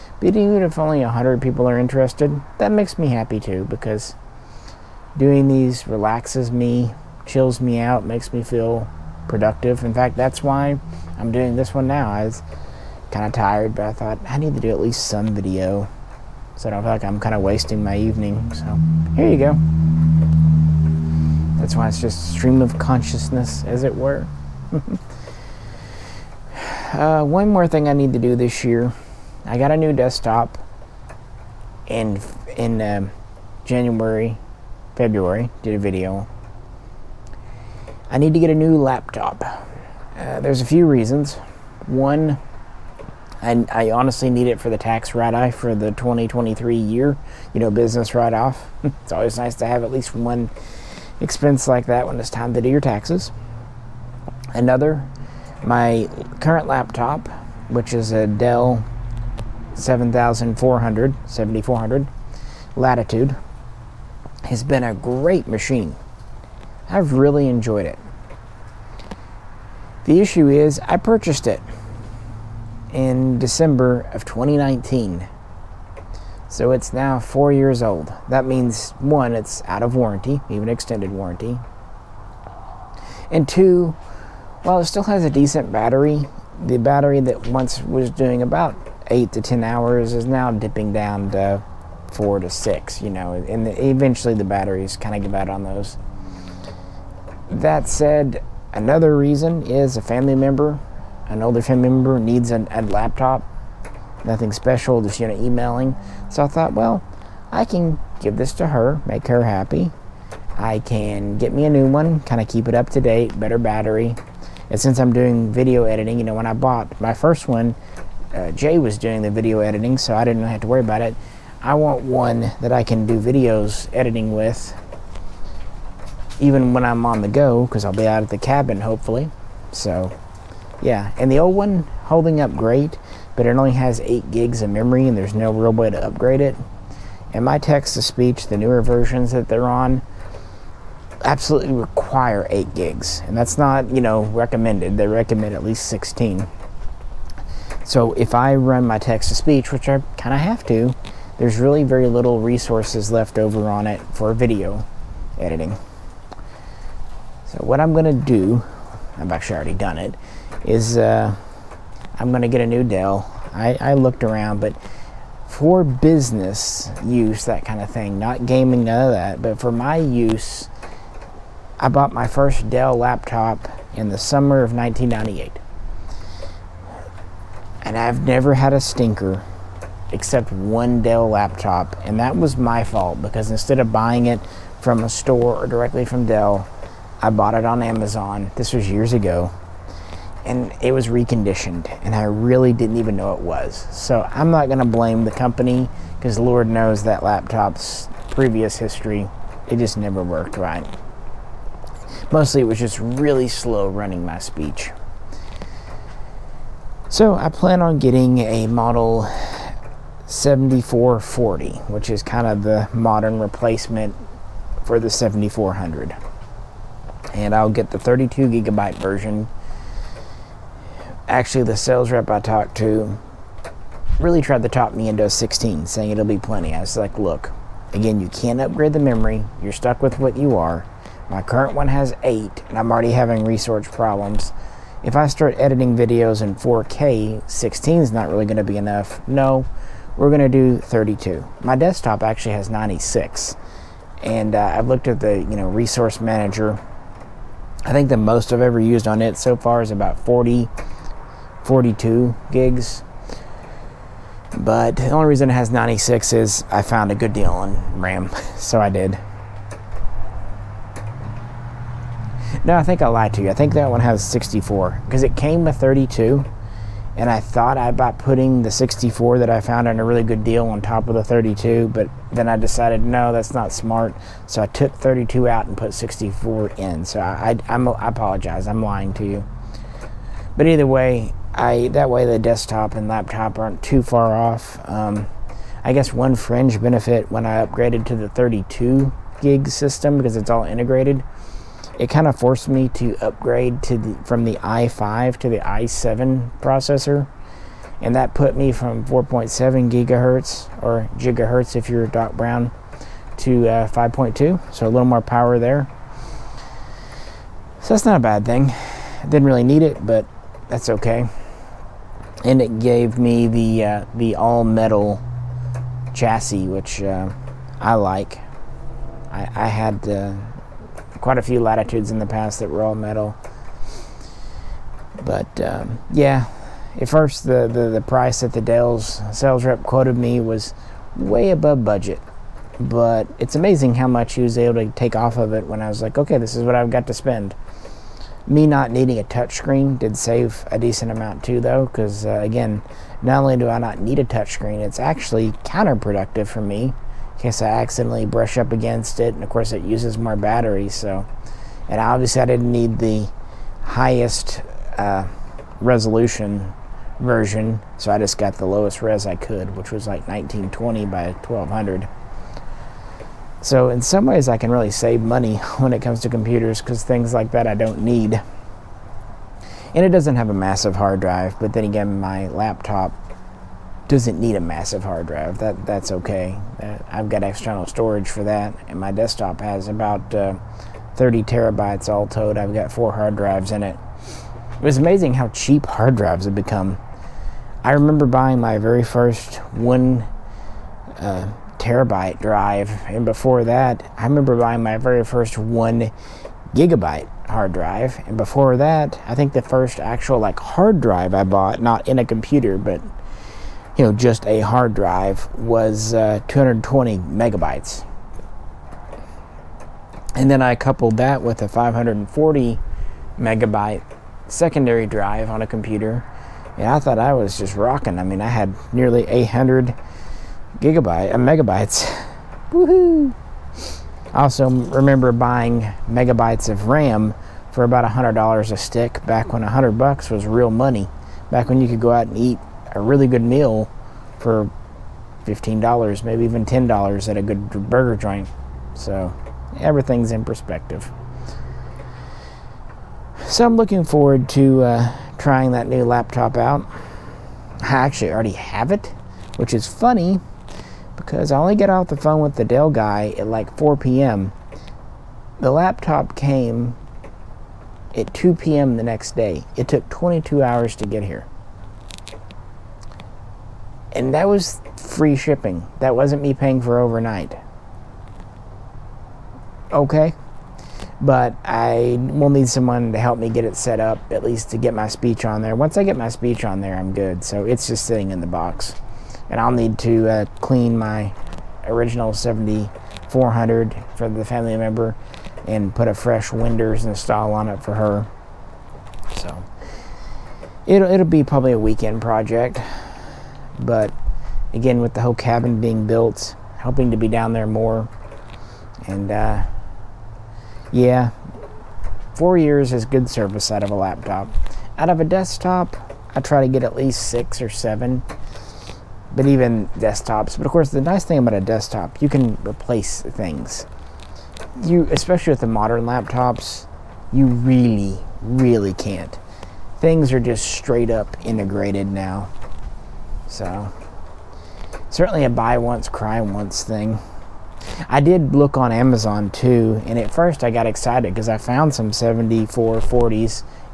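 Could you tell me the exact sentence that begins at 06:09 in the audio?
And it doesn't have a massive hard drive, but then again, my laptop doesn't need a massive hard drive.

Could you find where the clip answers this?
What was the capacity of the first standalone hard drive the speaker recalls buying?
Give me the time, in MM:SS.
06:46.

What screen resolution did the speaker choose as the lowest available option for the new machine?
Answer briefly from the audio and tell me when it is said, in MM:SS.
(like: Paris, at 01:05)
1920 by 1200, at 06:00.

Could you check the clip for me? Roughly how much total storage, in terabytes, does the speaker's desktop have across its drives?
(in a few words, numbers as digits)
30 terabytes.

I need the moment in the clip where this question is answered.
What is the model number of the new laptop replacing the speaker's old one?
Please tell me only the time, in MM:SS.
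03:30.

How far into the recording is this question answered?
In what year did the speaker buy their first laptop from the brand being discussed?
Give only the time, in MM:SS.
02:54.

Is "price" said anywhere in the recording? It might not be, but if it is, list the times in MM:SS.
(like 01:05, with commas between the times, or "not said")
05:28.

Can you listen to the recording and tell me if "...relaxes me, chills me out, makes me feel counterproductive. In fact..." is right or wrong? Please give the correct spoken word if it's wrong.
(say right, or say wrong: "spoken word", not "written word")
wrong: "productive", not "counterproductive".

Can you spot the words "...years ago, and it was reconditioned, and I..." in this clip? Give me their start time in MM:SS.
03:08.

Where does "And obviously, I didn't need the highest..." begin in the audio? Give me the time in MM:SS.
05:51.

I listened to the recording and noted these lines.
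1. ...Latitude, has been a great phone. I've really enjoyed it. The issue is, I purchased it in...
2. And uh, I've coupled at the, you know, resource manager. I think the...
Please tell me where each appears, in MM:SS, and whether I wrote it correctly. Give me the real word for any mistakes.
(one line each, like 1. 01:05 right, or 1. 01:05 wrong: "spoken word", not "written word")
1. 01:02 wrong: "machine", not "phone"
2. 04:04 wrong: "looked", not "coupled".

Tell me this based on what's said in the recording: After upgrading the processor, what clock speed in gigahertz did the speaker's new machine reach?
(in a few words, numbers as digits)
5.2.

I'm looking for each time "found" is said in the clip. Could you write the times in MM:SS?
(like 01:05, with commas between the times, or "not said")
04:16, 04:29, 08:51.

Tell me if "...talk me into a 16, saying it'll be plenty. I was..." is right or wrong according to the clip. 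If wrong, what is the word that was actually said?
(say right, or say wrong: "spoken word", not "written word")
right.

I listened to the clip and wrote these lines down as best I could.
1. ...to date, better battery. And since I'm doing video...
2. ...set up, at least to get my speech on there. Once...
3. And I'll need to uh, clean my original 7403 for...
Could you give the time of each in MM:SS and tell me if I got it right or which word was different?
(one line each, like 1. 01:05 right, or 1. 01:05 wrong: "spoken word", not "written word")
1. 01:52 right
2. 07:53 right
3. 07:59 wrong: "7400", not "7403".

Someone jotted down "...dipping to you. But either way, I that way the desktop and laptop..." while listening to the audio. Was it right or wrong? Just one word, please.
wrong.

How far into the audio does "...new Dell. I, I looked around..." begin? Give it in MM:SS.
02:42.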